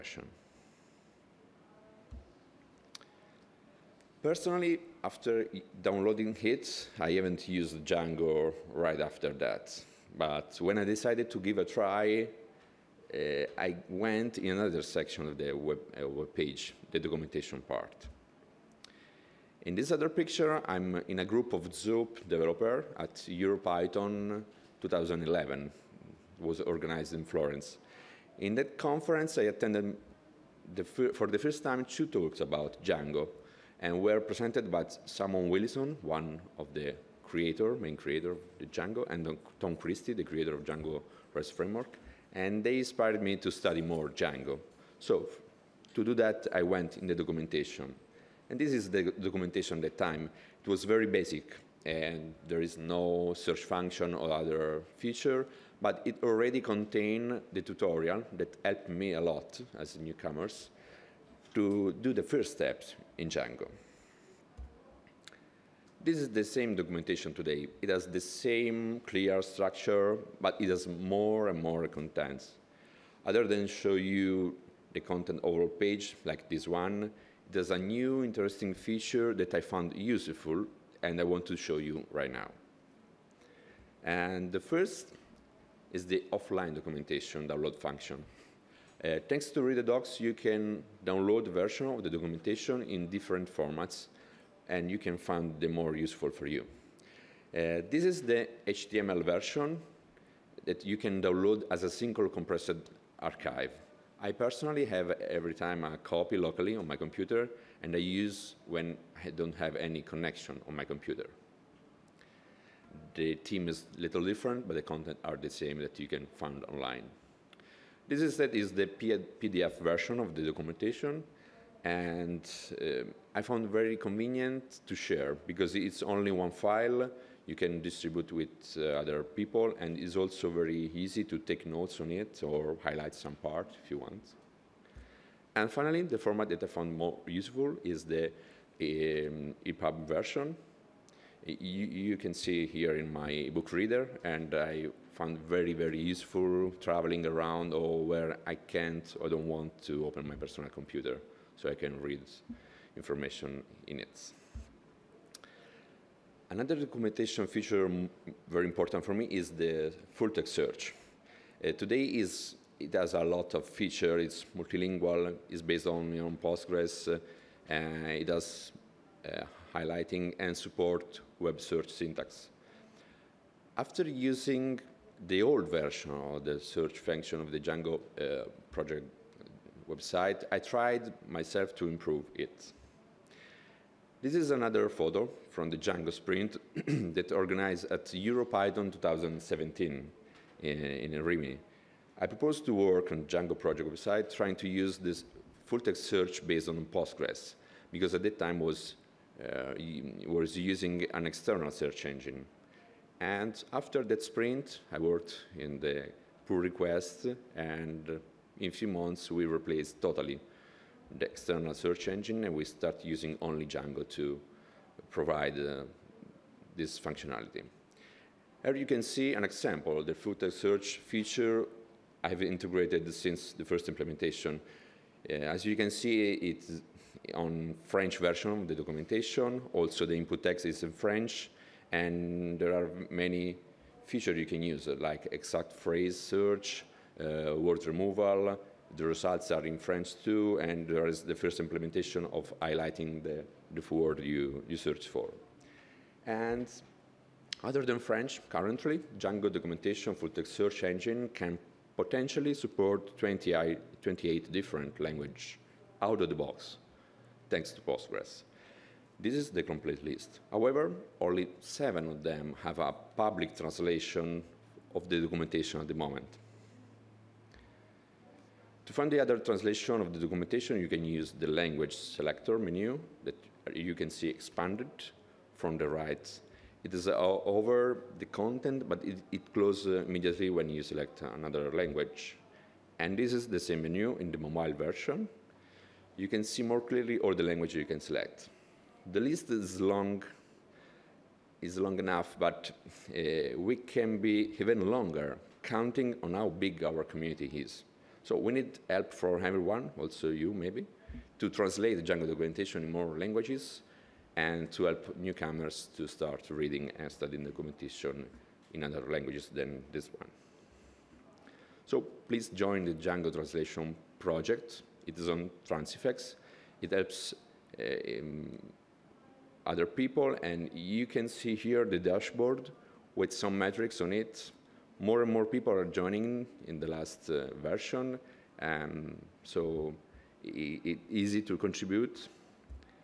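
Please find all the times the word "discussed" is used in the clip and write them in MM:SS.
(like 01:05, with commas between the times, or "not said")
not said.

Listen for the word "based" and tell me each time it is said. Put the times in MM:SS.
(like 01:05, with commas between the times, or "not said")
02:45, 03:16.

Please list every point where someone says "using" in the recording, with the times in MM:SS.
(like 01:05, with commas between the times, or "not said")
02:54, 03:20, 03:33.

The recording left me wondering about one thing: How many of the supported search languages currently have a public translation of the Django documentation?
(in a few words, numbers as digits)
7.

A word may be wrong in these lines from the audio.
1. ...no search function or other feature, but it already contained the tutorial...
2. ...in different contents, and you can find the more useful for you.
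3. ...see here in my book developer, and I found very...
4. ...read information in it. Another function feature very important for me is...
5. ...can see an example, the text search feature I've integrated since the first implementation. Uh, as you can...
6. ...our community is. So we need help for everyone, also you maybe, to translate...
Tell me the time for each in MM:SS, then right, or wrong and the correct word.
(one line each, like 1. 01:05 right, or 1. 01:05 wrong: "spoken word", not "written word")
1. 00:52 right
2. 01:32 wrong: "formats", not "contents"
3. 02:22 wrong: "reader", not "developer"
4. 02:31 wrong: "documentation", not "function"
5. 03:38 right
6. 04:56 right.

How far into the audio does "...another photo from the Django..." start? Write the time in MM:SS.
03:04.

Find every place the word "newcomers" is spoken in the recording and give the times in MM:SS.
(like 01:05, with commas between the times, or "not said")
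00:59, 05:05.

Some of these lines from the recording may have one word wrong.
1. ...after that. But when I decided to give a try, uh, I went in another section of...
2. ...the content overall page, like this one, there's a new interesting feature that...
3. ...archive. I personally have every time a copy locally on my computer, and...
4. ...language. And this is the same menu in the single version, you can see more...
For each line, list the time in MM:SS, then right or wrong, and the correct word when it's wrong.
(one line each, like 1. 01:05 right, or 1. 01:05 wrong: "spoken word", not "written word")
1. 00:09 right
2. 01:14 right
3. 01:43 right
4. 04:41 wrong: "mobile", not "single".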